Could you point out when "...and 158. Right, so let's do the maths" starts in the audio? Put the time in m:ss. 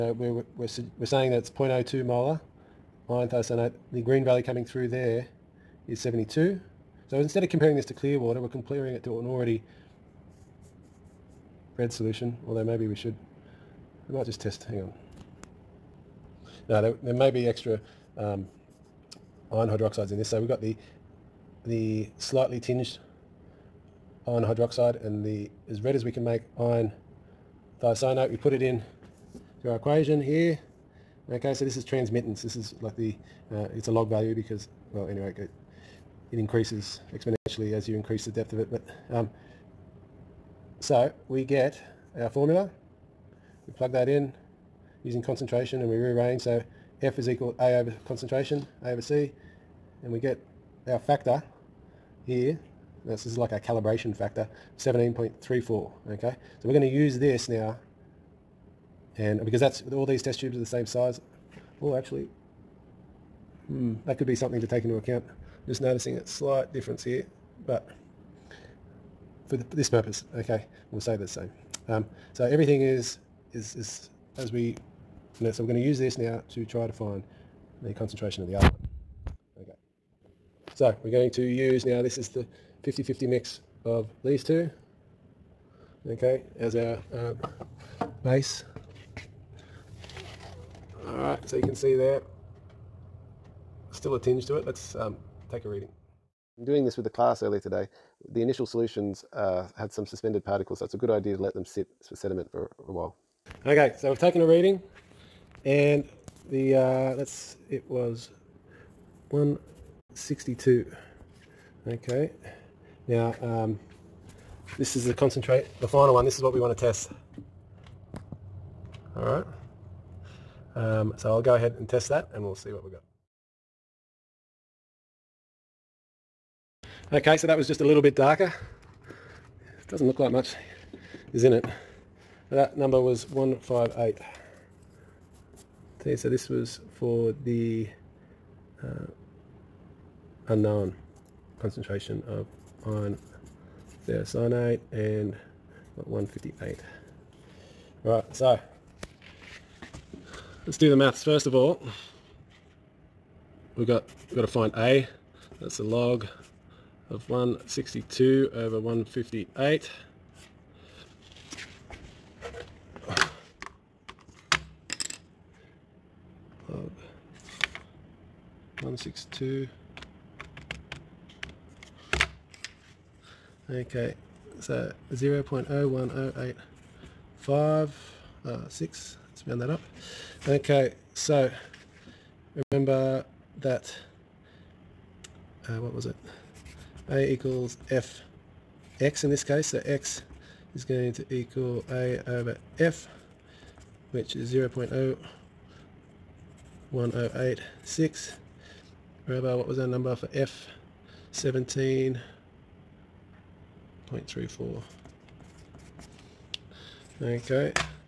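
2:24.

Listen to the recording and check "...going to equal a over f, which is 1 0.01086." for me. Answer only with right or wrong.
wrong.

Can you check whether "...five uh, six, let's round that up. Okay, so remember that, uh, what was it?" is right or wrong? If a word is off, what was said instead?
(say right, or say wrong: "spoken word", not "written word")
right.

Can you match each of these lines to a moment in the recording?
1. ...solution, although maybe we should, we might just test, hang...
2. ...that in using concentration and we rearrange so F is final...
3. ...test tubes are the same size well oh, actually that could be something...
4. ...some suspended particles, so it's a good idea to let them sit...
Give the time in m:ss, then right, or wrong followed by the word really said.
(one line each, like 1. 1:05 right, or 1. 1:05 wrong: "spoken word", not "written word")
1. 0:11 right
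2. 0:43 wrong: "equal", not "final"
3. 1:00 right
4. 1:39 right.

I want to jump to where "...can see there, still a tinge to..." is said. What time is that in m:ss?
1:31.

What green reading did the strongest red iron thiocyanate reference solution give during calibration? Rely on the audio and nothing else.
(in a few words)
72.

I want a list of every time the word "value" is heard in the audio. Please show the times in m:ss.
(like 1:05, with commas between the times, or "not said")
0:04, 0:34.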